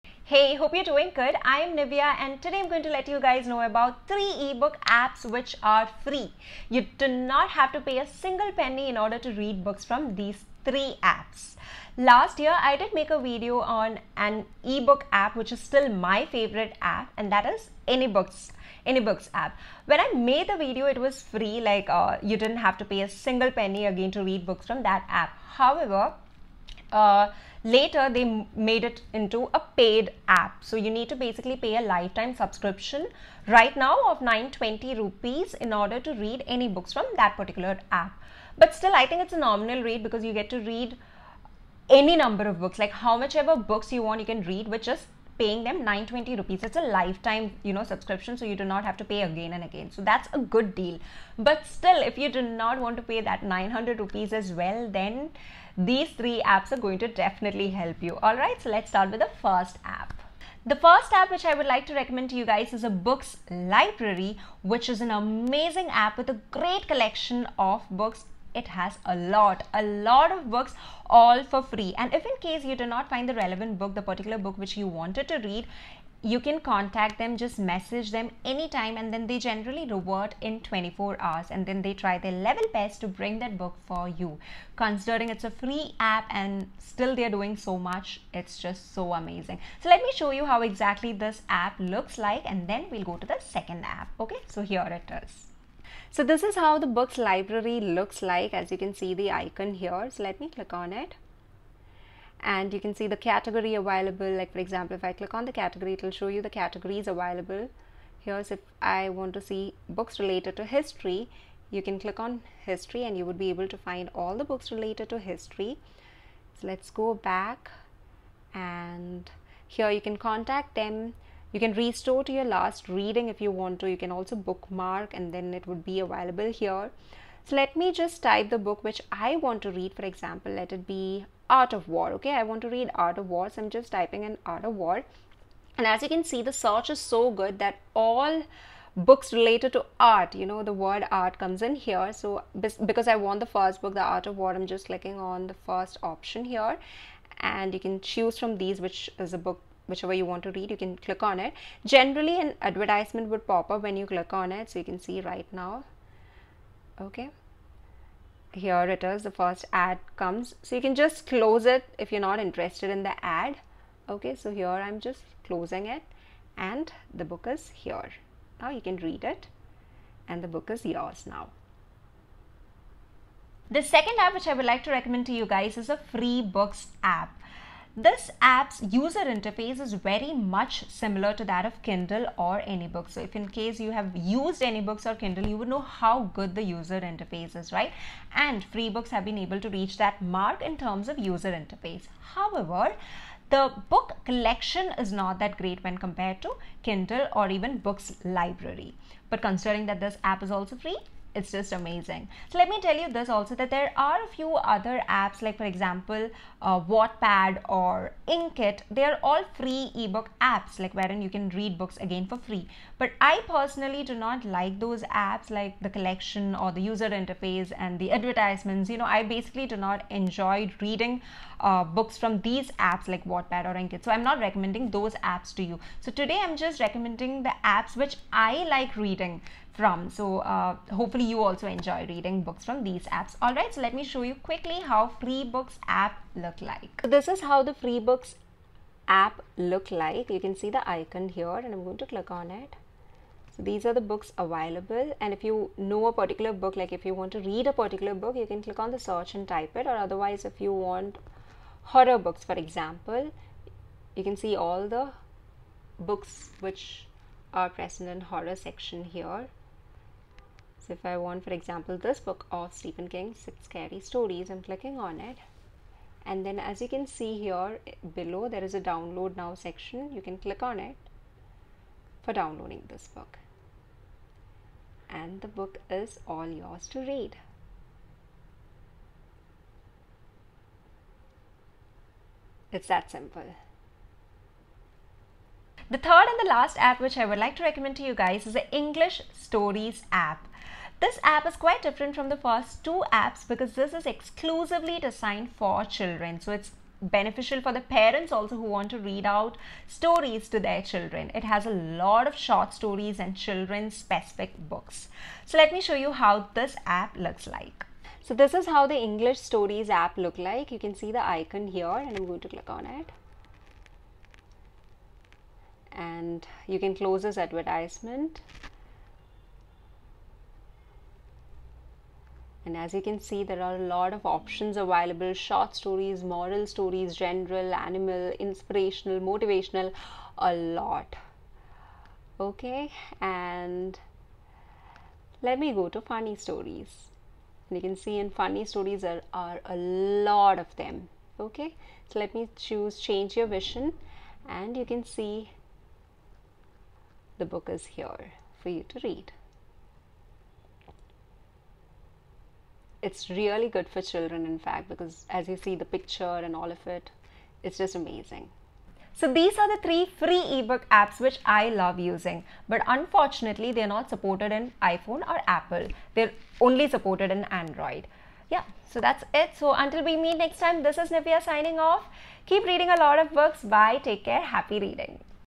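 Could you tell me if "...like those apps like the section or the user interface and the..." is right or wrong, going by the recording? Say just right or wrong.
wrong.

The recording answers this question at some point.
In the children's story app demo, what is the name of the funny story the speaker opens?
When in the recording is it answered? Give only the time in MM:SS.
05:42.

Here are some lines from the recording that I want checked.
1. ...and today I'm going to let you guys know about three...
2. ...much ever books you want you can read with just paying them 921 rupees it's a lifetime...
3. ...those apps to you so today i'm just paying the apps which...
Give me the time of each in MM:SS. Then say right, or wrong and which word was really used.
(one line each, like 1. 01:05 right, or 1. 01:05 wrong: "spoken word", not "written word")
1. 00:02 right
2. 00:43 wrong: "920", not "921"
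3. 03:44 wrong: "recommending", not "paying".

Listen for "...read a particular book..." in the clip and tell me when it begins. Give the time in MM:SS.
04:07.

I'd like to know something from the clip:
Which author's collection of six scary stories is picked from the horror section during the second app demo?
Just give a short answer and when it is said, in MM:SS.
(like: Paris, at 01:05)
Stephen King, at 04:22.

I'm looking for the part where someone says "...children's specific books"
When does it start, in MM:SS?
05:03.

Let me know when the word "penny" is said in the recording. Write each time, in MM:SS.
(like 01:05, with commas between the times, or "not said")
00:08, 00:23.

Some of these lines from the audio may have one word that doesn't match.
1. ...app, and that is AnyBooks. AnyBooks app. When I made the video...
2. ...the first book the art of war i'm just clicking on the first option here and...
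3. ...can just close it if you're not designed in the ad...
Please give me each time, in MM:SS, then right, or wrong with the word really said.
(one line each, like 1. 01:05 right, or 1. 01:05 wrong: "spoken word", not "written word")
1. 00:16 right
2. 02:23 right
3. 02:40 wrong: "interested", not "designed".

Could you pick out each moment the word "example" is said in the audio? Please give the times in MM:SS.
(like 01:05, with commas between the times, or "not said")
01:44, 02:10, 03:25, 04:12, 04:21.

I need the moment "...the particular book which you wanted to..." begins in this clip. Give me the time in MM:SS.
01:13.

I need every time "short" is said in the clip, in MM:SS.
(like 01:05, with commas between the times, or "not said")
05:02, 05:25.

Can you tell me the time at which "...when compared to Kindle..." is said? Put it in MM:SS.
03:15.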